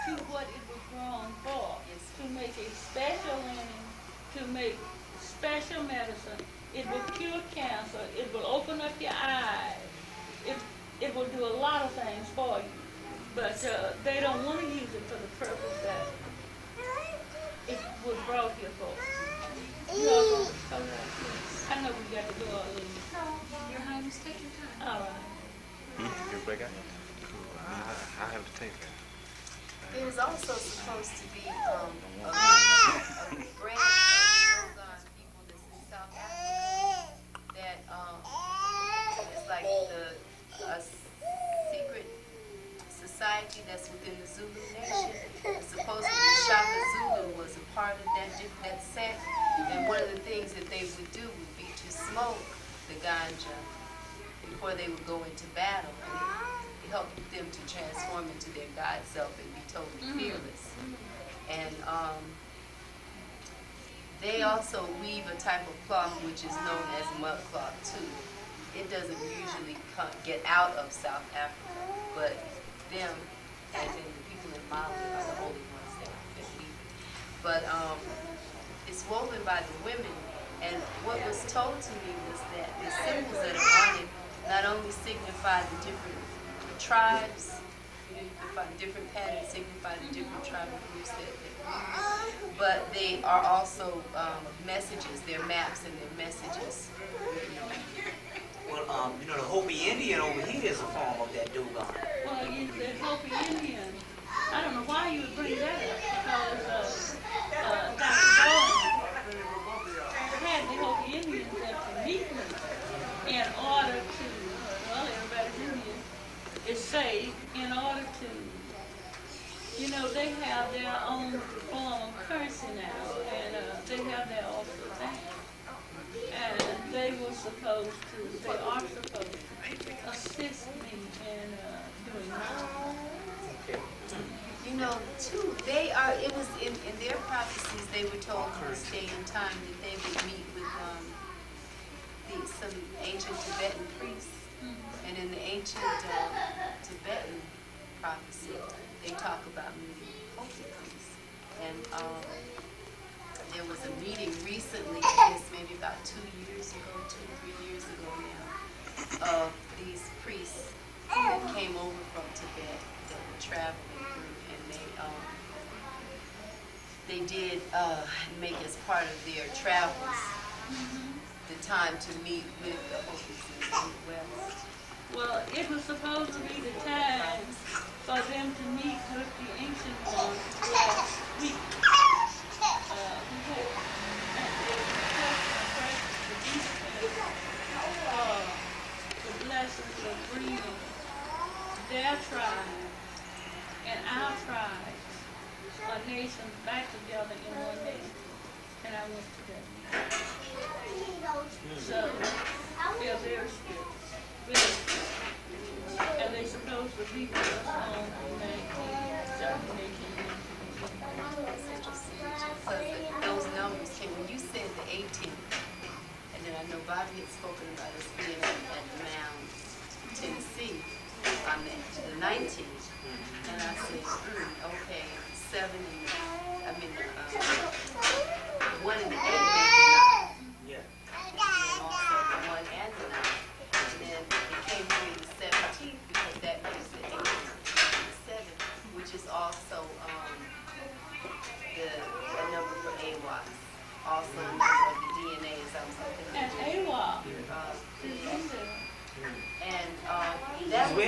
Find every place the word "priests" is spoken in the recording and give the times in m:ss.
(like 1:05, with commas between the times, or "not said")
2:23, 2:30, 2:40.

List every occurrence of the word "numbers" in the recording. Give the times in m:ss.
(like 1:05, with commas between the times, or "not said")
3:33, 4:02.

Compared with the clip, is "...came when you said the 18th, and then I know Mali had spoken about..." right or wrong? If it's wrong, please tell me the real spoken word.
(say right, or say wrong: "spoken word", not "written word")
wrong: "Bobby", not "Mali".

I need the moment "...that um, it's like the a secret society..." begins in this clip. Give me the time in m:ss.
0:37.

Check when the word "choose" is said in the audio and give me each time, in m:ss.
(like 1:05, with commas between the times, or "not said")
not said.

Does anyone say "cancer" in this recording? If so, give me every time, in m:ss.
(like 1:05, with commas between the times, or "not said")
0:07.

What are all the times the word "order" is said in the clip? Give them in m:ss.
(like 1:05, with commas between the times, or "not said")
1:53, 1:57.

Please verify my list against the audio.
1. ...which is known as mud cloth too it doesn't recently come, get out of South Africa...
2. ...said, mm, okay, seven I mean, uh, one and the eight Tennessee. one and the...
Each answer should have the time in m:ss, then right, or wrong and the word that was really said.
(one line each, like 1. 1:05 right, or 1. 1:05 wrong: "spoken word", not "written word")
1. 1:06 wrong: "usually", not "recently"
2. 3:43 wrong: "Yeah", not "Tennessee".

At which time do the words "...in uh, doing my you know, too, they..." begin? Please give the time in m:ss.
2:11.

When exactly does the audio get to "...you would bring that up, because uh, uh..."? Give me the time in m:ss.
1:45.